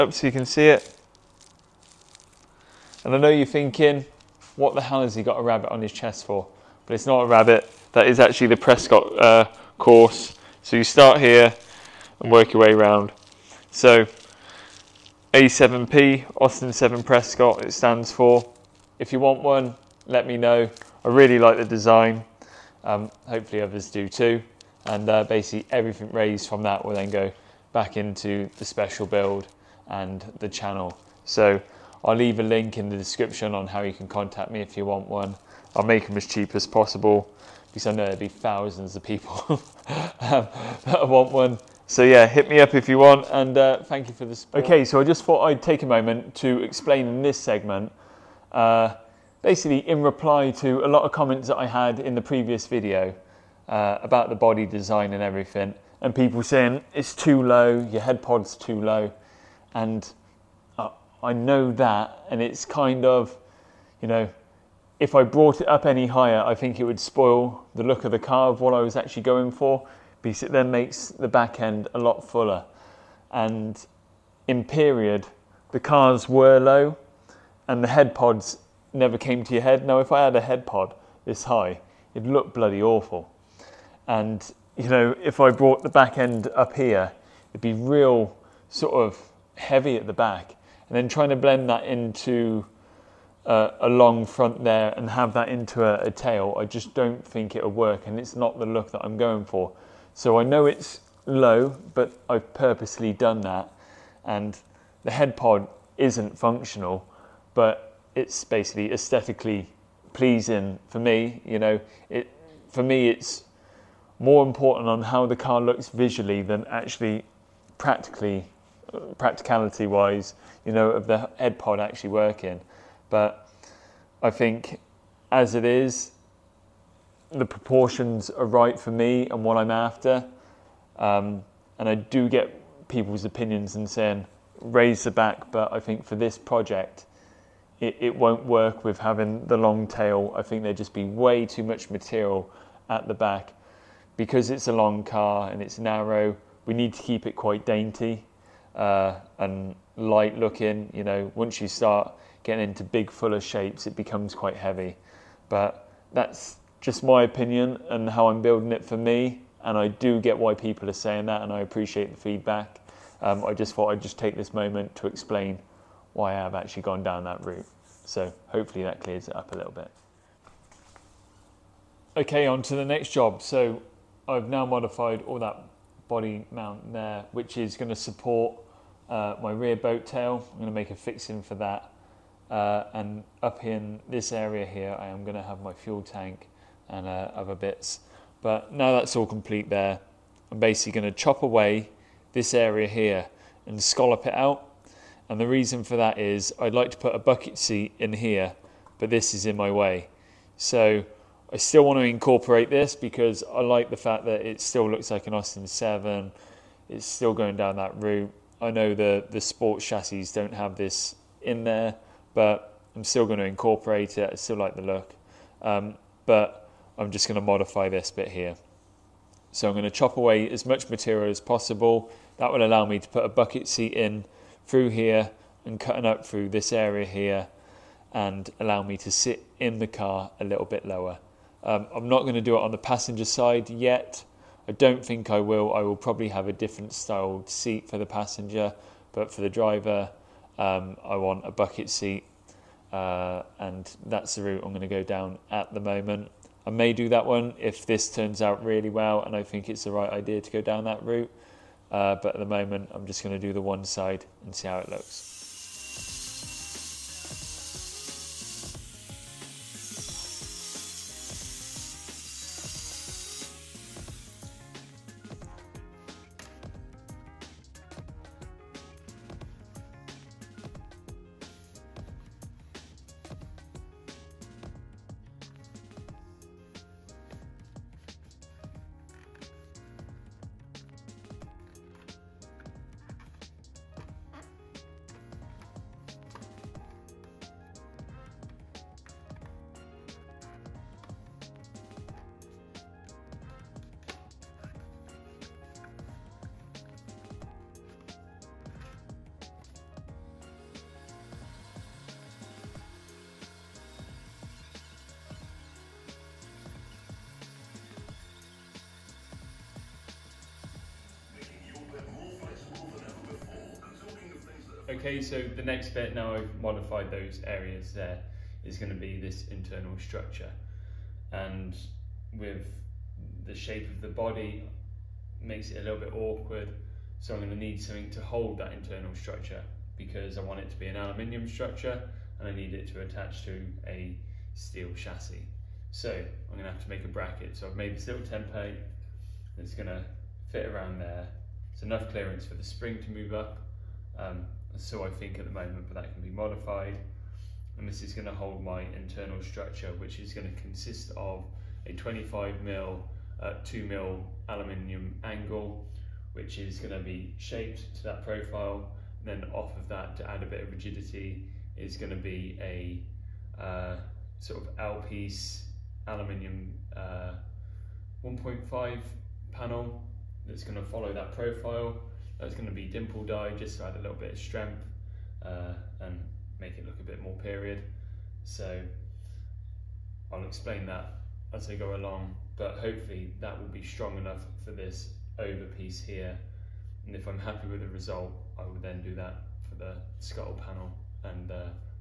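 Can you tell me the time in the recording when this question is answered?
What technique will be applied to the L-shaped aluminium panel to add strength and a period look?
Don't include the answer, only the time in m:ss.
6:12.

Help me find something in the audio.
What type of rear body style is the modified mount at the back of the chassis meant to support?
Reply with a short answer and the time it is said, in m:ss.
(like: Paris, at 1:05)
boat tail, at 2:59.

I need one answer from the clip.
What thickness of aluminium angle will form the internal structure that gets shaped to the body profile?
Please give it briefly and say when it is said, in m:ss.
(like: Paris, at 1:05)
2 mil, at 5:53.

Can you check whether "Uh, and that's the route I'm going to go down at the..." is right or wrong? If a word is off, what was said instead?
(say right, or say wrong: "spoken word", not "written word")
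right.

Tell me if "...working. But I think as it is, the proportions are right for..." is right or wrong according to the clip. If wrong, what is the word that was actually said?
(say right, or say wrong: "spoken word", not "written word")
right.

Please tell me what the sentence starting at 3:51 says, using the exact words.
Um, I'm not going to do it on the passenger side yet.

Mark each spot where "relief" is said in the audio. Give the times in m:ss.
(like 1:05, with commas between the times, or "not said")
not said.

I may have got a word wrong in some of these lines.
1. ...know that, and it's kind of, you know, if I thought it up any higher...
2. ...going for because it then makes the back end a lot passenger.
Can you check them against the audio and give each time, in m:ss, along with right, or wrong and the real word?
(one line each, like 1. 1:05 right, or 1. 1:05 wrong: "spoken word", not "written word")
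1. 1:01 wrong: "brought", not "thought"
2. 1:09 wrong: "fuller", not "passenger".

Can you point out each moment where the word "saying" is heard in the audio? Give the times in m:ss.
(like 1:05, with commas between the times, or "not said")
0:56, 2:13, 2:40.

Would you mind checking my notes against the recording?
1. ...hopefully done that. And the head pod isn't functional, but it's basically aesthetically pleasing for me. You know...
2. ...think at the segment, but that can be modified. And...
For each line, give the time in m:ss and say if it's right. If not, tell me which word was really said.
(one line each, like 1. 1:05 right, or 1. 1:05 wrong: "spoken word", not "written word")
1. 1:42 wrong: "purposely", not "hopefully"
2. 5:45 wrong: "moment", not "segment".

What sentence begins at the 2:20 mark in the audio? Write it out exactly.
I think there'd just be way too much material at the back.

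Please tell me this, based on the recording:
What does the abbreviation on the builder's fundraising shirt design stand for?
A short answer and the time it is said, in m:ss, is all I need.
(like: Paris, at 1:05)
Austin 7 Prescott, at 0:16.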